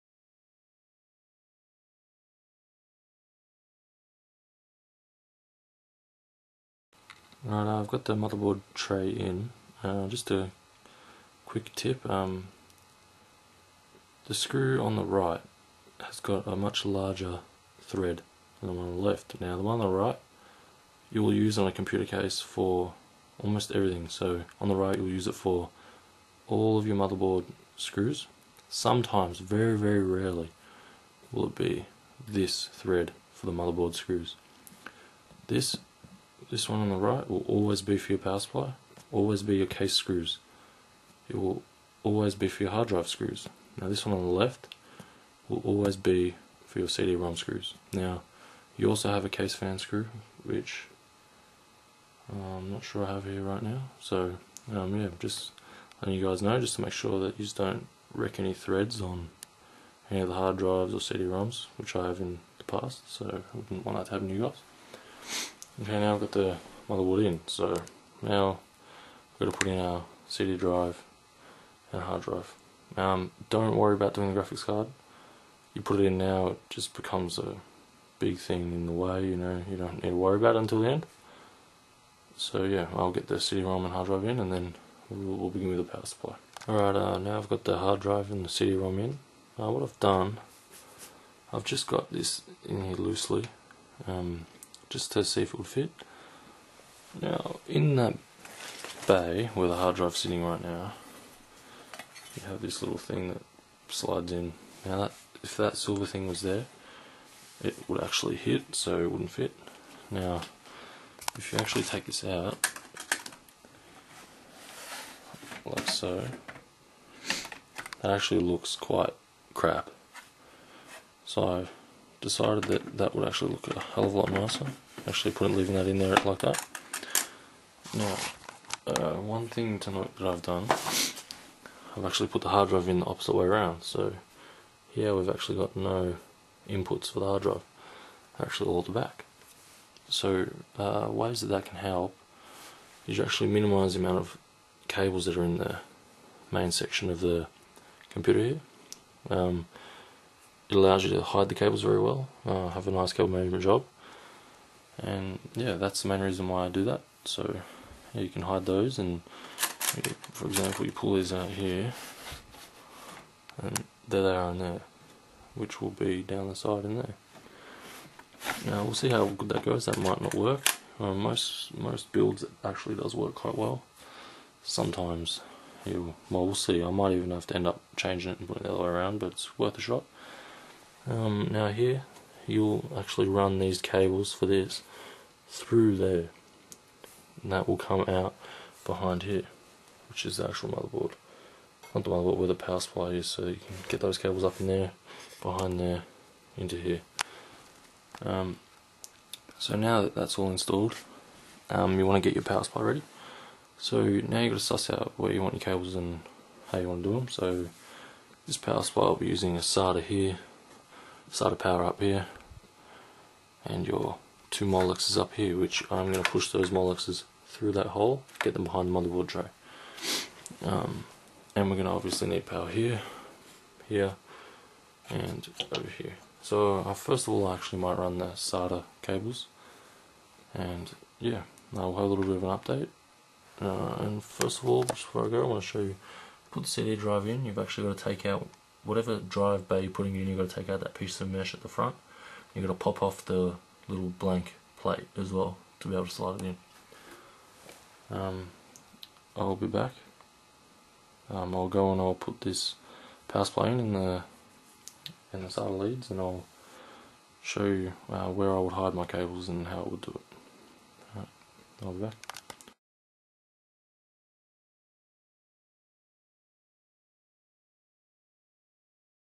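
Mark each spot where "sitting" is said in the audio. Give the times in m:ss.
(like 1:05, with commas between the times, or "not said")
1:40.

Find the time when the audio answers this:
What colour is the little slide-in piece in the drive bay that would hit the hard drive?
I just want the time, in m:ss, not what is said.
1:45.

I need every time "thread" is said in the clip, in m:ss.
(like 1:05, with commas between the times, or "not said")
0:17, 0:32, 0:58.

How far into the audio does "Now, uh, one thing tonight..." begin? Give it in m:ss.
2:07.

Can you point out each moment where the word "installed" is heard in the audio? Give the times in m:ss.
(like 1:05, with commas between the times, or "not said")
3:20.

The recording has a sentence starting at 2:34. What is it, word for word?
And yeah, that's the main reason why I do that.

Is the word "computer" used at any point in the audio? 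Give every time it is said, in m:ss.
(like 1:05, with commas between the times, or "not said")
0:21, 2:28.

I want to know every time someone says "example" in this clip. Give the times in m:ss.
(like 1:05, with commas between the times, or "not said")
2:40.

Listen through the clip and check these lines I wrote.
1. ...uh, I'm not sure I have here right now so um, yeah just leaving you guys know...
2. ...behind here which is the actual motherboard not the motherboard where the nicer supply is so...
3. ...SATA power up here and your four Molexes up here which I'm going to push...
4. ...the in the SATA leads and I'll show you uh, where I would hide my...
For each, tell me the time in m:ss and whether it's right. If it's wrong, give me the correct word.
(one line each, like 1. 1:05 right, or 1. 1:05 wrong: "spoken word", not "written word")
1. 0:52 wrong: "letting", not "leaving"
2. 3:08 wrong: "power", not "nicer"
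3. 3:31 wrong: "two", not "four"
4. 4:13 right.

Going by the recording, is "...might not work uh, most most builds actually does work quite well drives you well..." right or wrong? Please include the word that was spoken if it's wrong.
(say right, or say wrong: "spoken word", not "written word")
wrong: "sometimes", not "drives".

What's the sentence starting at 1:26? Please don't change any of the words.
Alright, uh, now I've got the hard drive and the CD-ROM in.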